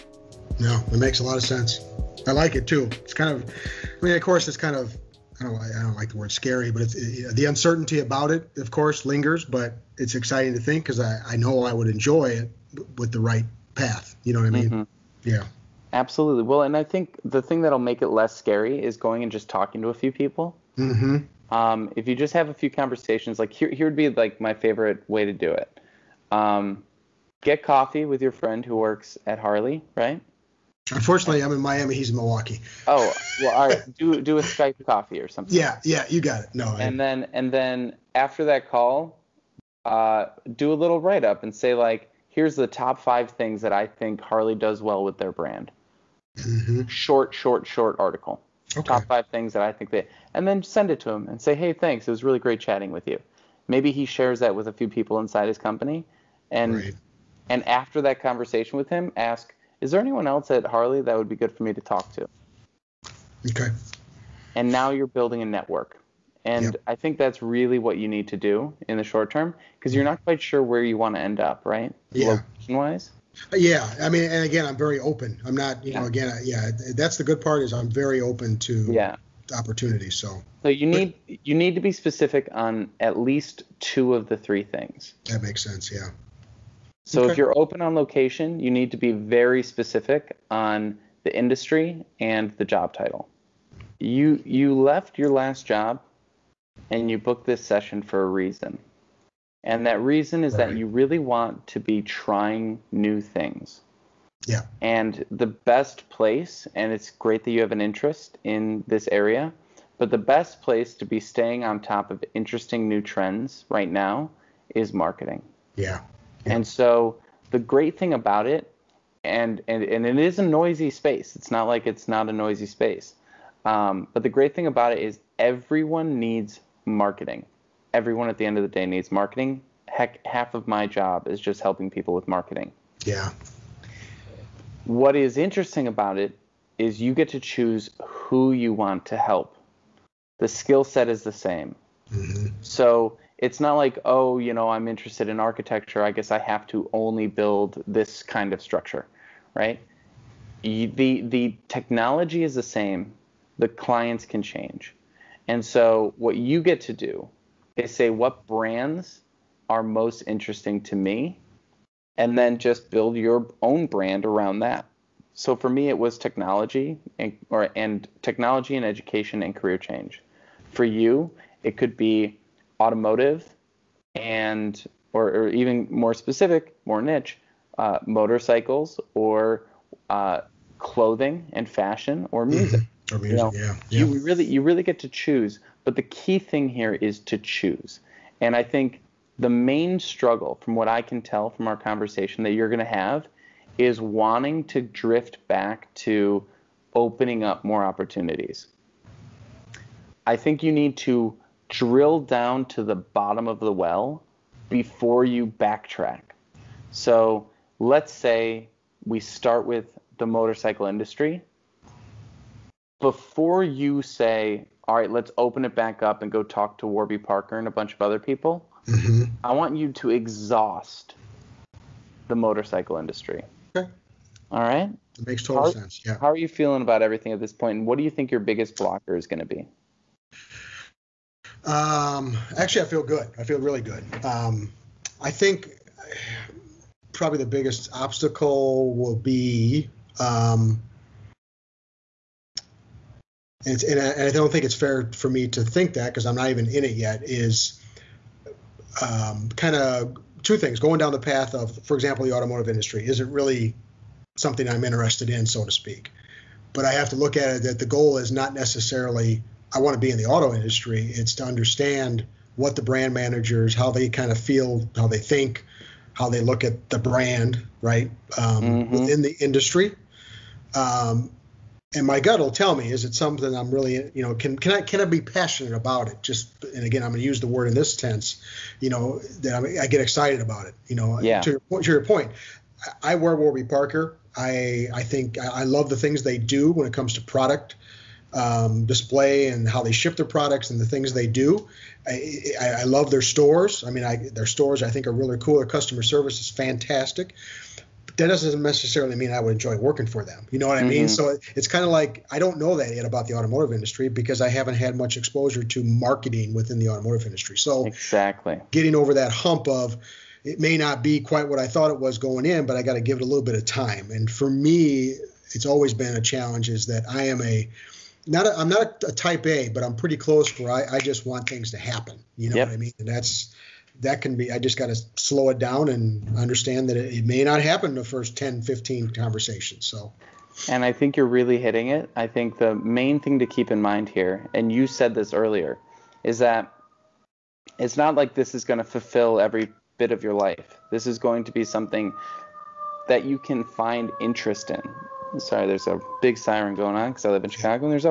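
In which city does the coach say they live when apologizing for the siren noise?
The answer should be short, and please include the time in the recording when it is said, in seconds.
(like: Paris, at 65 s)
Chicago, at 347 s.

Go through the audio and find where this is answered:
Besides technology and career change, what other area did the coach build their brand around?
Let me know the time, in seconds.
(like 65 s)
168 s.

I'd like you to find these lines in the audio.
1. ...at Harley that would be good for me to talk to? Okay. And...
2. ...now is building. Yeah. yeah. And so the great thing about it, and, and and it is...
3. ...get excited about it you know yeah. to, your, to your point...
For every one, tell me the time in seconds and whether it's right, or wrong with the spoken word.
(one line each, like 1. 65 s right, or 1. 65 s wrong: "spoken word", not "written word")
1. 60 s right
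2. 113 s wrong: "marketing", not "building"
3. 279 s right.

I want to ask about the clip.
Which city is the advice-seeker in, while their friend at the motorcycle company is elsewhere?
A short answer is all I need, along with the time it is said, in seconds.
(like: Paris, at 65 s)
Miami, at 31 s.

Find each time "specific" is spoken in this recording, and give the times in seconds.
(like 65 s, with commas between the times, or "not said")
81 s, 89 s, 176 s.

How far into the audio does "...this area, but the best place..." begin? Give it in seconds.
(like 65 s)
108 s.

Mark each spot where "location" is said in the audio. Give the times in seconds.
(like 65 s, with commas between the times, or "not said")
72 s, 87 s.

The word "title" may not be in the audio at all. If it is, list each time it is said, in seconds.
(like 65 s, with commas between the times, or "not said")
92 s.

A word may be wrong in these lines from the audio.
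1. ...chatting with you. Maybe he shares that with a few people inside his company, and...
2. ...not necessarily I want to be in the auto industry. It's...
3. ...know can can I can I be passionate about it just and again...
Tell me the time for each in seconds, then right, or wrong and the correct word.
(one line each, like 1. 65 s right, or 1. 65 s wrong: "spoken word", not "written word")
1. 52 s right
2. 258 s right
3. 274 s right.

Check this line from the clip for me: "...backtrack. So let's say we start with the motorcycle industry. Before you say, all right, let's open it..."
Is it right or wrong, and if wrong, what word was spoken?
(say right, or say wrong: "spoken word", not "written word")
right.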